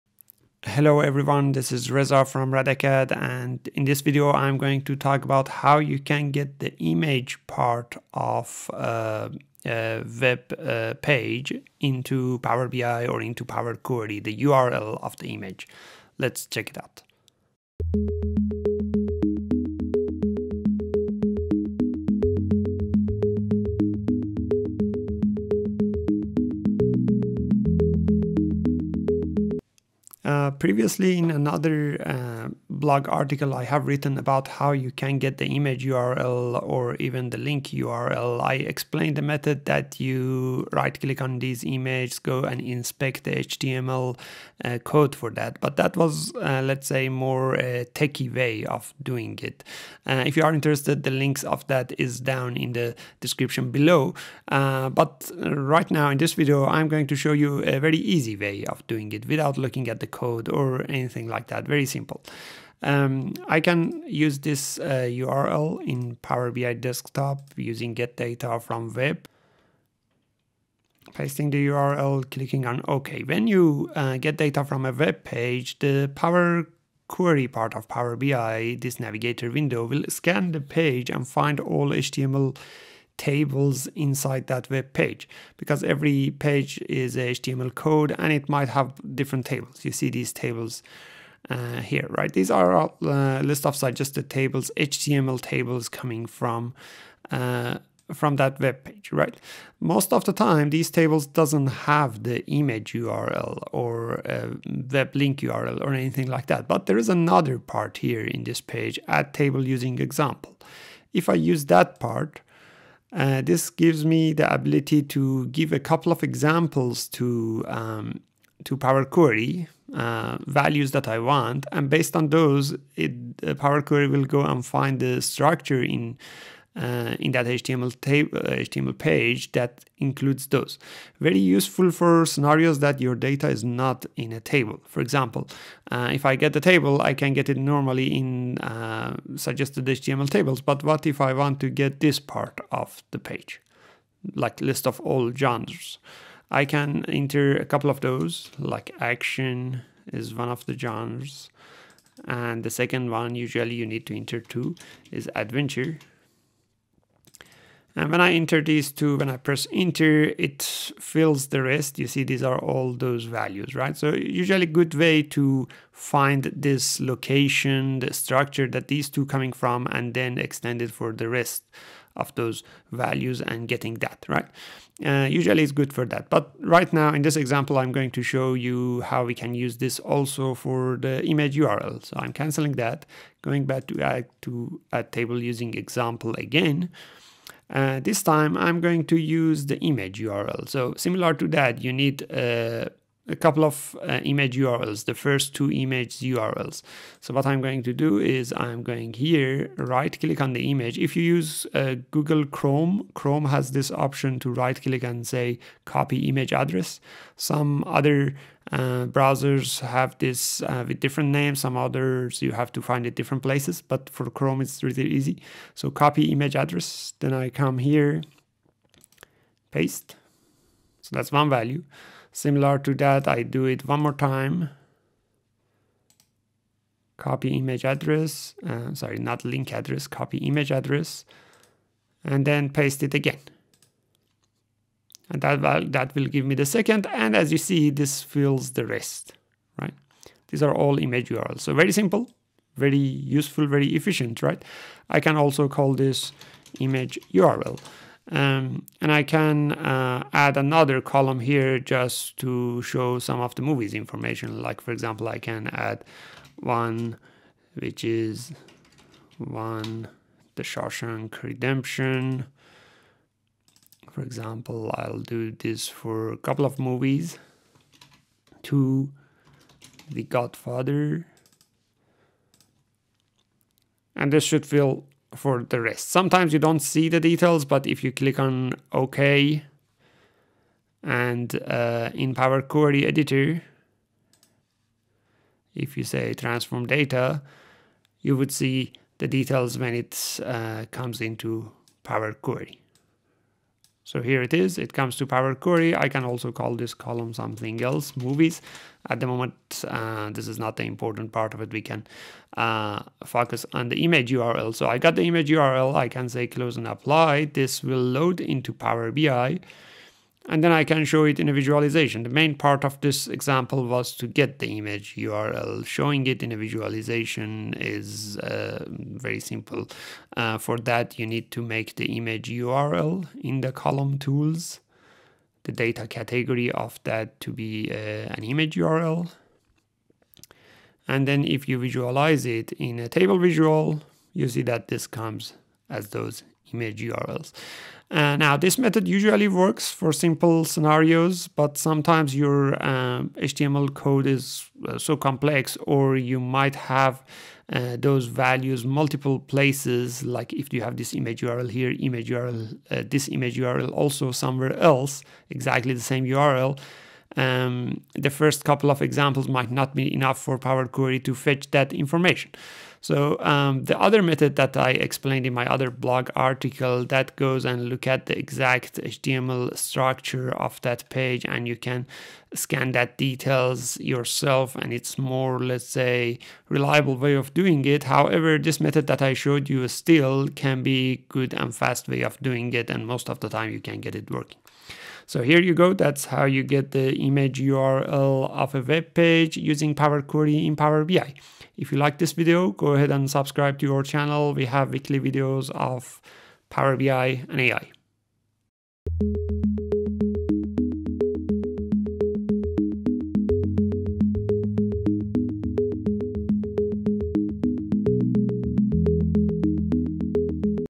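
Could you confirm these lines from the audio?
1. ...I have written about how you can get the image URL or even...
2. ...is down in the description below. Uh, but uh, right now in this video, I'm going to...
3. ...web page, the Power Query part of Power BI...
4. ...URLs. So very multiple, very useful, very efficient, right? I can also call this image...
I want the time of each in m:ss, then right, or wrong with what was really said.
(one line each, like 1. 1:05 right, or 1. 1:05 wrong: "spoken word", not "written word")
1. 0:33 right
2. 0:51 right
3. 1:14 right
4. 4:01 wrong: "simple", not "multiple".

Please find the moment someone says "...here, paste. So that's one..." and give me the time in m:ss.
3:37.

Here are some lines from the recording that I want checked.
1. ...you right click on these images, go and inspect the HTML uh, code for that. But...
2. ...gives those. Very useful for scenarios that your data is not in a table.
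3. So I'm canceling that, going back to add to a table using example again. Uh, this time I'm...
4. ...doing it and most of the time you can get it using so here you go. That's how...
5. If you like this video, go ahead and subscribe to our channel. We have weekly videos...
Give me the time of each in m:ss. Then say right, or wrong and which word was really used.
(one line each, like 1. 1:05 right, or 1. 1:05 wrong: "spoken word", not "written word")
1. 0:39 right
2. 2:09 wrong: "includes", not "gives"
3. 3:02 right
4. 6:22 wrong: "working", not "using"
5. 6:31 right.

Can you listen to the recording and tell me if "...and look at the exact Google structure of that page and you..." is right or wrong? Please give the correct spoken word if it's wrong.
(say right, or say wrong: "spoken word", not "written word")
wrong: "HTML", not "Google".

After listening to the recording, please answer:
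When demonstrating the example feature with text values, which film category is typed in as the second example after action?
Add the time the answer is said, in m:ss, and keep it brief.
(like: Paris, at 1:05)
Adventure, at 2:35.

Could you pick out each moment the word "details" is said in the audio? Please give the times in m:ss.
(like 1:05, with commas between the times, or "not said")
4:37, 4:49, 6:13.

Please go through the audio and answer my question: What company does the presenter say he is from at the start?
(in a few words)
RADACAD.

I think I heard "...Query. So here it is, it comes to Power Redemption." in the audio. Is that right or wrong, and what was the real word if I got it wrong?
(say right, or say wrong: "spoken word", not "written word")
wrong: "Query", not "Redemption".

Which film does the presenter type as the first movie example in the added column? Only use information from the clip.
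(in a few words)
The Shawshank Redemption.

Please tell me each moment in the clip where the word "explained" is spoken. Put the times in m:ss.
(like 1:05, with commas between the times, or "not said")
0:38, 6:04.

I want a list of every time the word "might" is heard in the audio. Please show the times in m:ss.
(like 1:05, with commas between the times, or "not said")
1:28, 5:46, 5:59.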